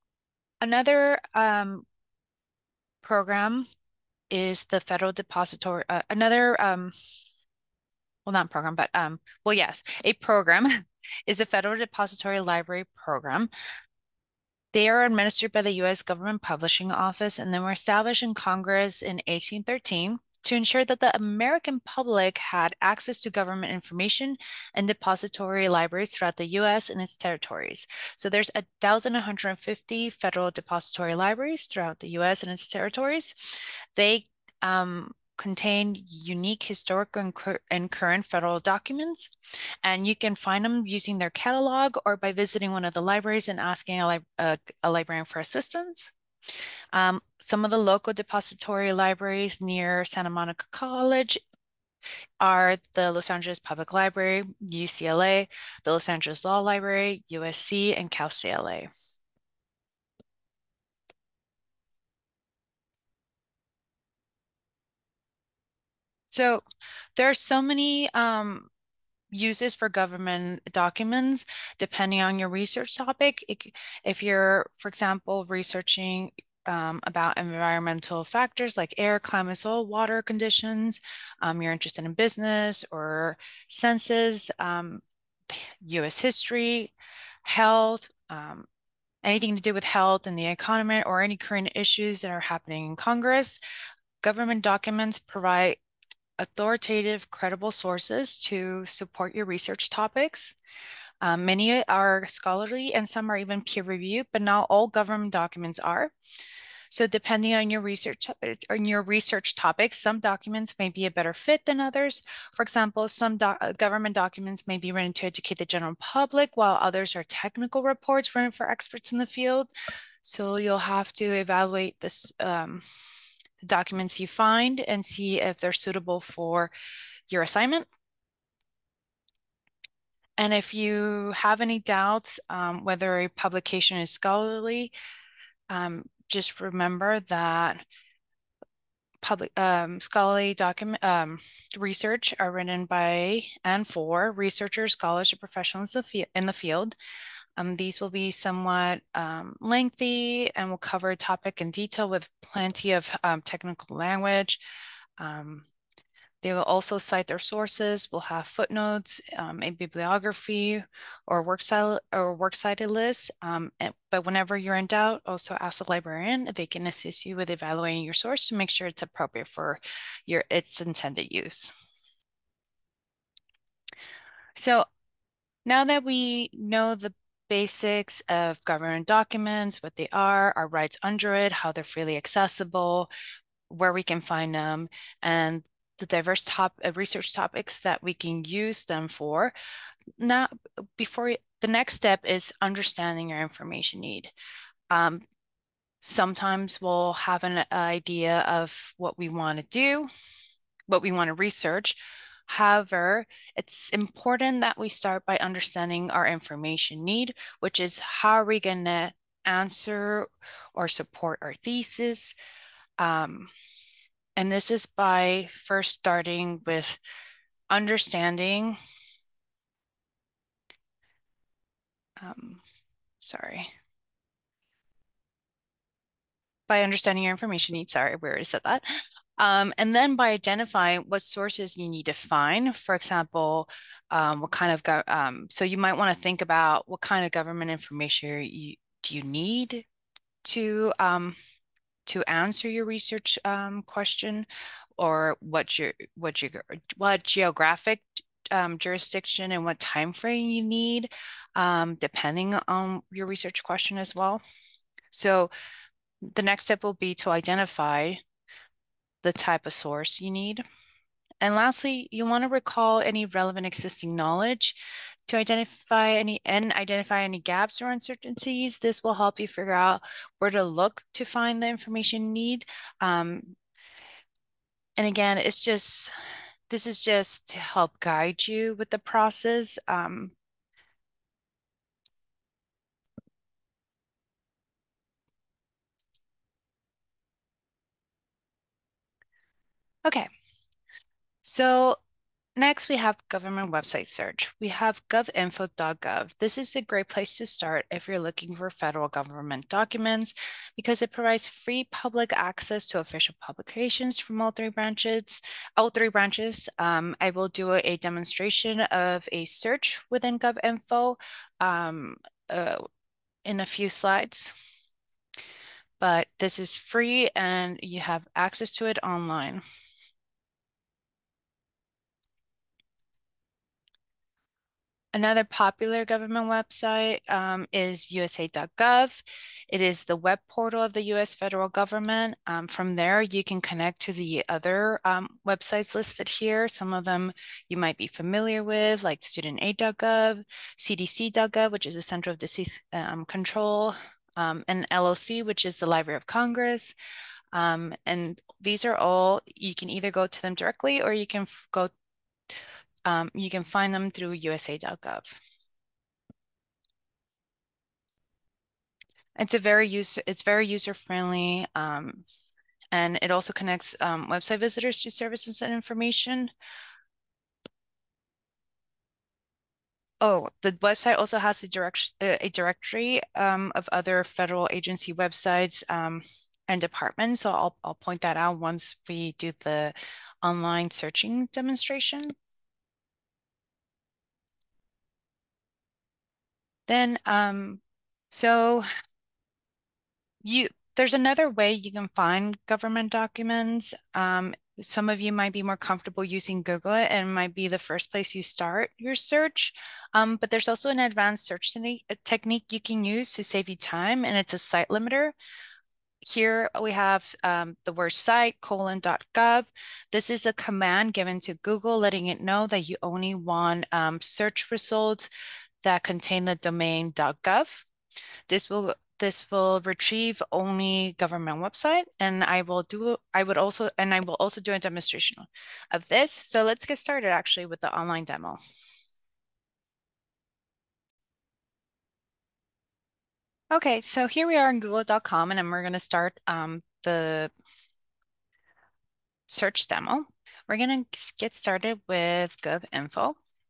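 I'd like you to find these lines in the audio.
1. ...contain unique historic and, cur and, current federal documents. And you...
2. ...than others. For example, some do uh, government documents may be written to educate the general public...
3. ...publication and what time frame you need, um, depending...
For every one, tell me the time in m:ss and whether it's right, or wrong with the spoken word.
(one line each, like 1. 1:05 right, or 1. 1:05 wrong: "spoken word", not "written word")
1. 0:35 right
2. 1:51 right
3. 4:08 wrong: "jurisdiction", not "publication".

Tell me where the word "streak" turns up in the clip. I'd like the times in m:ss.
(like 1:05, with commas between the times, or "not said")
not said.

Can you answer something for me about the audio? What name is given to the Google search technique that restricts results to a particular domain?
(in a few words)
site limiter.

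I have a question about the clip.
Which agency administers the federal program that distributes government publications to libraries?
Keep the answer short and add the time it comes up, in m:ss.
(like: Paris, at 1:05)
U.S. Government Publishing Office, at 0:15.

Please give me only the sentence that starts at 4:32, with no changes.
Um, and again, it's just this is just to help guide you with the process.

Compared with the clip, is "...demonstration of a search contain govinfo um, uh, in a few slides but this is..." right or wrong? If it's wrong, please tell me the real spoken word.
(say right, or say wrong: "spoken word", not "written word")
wrong: "within", not "contain".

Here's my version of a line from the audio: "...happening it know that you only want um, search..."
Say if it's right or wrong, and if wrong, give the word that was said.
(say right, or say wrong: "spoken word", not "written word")
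wrong: "letting", not "happening".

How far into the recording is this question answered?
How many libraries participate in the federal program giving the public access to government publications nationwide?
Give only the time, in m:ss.
0:28.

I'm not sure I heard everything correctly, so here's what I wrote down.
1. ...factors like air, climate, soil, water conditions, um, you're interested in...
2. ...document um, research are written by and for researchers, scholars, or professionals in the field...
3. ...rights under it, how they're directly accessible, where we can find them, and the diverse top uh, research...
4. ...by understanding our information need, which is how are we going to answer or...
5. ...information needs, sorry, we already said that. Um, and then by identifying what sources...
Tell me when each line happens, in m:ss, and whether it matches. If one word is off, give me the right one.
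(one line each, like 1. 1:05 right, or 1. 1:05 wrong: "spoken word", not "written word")
1. 1:18 right
2. 2:20 right
3. 3:00 wrong: "freely", not "directly"
4. 3:25 right
5. 3:47 right.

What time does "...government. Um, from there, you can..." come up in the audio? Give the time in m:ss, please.
5:31.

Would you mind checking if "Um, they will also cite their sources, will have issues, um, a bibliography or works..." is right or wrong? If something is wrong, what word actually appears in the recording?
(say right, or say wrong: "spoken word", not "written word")
wrong: "footnotes", not "issues".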